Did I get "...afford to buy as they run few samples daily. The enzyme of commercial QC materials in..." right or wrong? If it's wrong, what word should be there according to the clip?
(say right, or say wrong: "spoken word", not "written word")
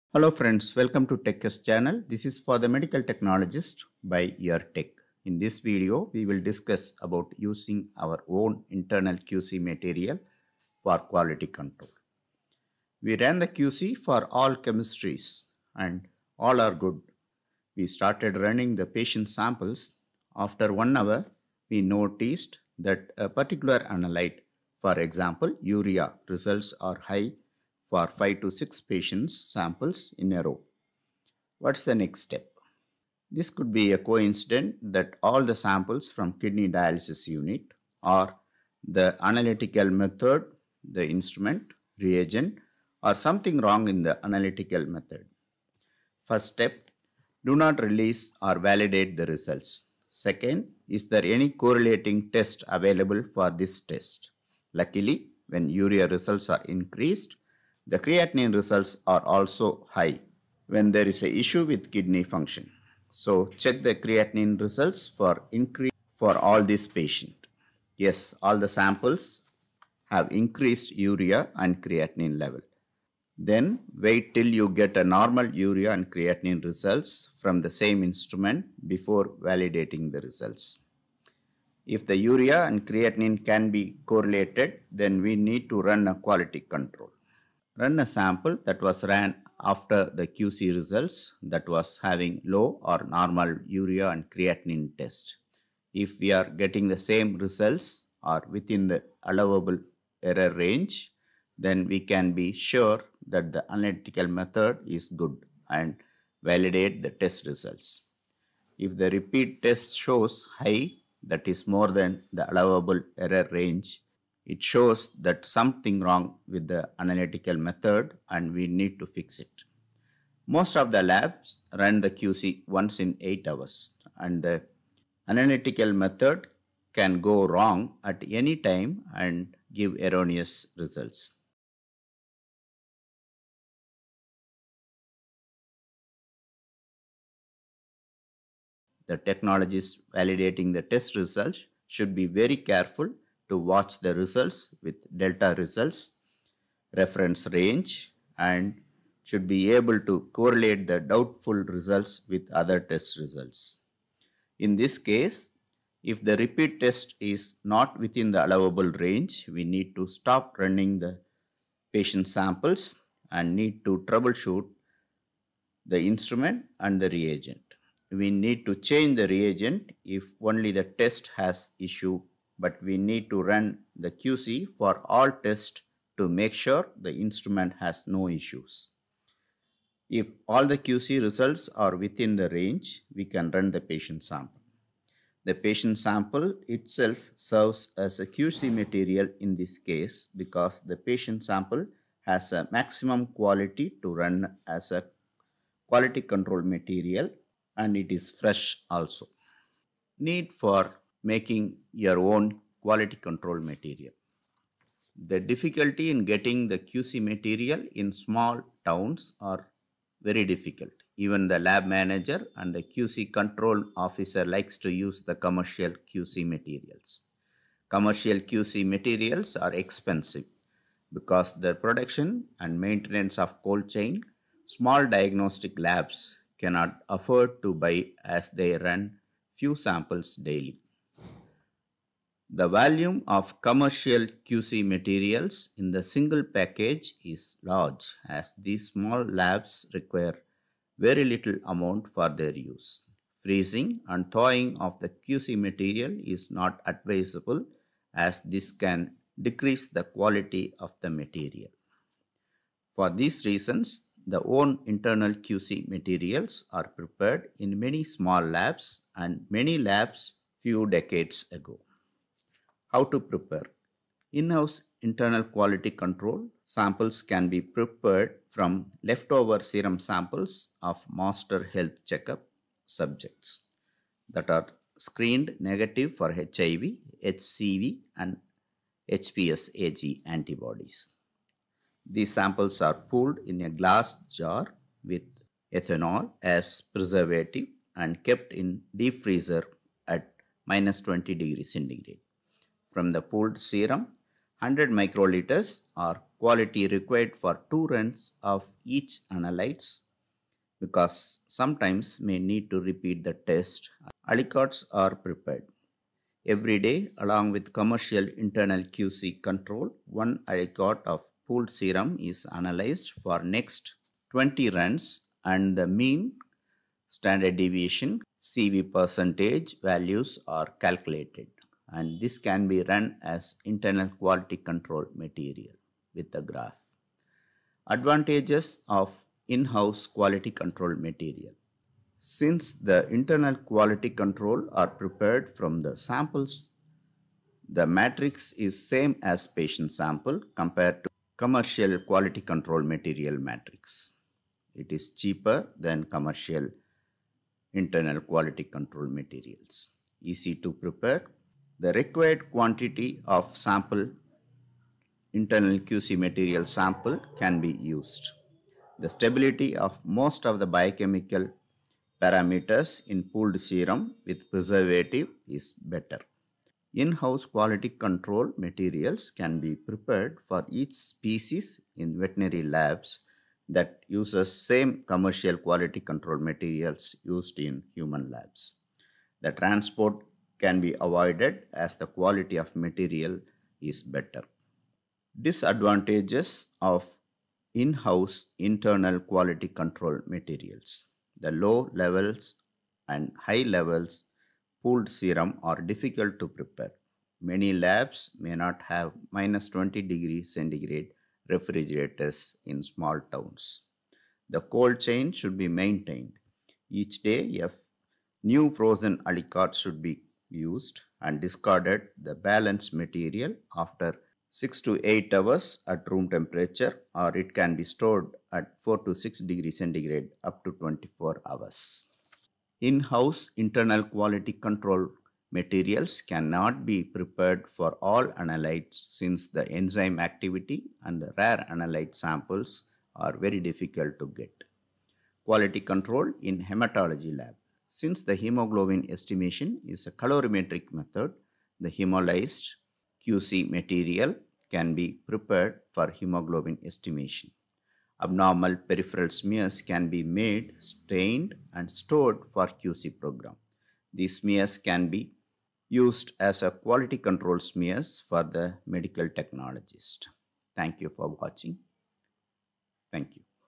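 wrong: "volume", not "enzyme".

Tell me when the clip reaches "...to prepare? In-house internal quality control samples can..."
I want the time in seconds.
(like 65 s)
263 s.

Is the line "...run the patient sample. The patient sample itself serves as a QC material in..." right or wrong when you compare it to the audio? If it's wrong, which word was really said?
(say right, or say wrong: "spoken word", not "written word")
right.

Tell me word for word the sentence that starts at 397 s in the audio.
Many labs may not have minus 20 degree centigrade refrigerators in small towns.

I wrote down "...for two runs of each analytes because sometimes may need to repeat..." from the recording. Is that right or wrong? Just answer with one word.
right.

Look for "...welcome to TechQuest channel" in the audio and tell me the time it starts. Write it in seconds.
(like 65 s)
0 s.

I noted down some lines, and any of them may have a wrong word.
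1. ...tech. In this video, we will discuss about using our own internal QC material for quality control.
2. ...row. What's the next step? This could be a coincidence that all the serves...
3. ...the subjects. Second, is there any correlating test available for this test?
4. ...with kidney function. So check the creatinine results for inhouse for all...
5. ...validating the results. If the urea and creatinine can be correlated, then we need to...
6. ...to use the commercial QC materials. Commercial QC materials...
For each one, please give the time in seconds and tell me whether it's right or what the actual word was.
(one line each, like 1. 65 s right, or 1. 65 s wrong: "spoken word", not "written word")
1. 4 s right
2. 30 s wrong: "samples", not "serves"
3. 49 s wrong: "results", not "subjects"
4. 61 s wrong: "increase", not "inhouse"
5. 79 s right
6. 214 s right.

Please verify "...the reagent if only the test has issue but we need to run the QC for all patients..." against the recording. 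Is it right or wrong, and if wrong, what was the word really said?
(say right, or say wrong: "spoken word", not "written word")
wrong: "tests", not "patients".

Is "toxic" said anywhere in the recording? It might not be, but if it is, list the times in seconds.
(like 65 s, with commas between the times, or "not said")
not said.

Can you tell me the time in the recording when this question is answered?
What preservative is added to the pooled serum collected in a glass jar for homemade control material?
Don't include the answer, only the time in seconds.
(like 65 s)
285 s.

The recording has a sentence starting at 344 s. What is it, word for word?
It is cheaper than commercial internal quality control materials.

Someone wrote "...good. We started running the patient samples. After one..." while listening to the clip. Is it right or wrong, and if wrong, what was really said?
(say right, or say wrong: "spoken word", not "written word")
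right.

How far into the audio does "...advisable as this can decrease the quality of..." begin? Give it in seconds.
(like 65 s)
246 s.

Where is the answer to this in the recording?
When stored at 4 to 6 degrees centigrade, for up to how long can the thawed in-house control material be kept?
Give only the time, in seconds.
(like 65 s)
420 s.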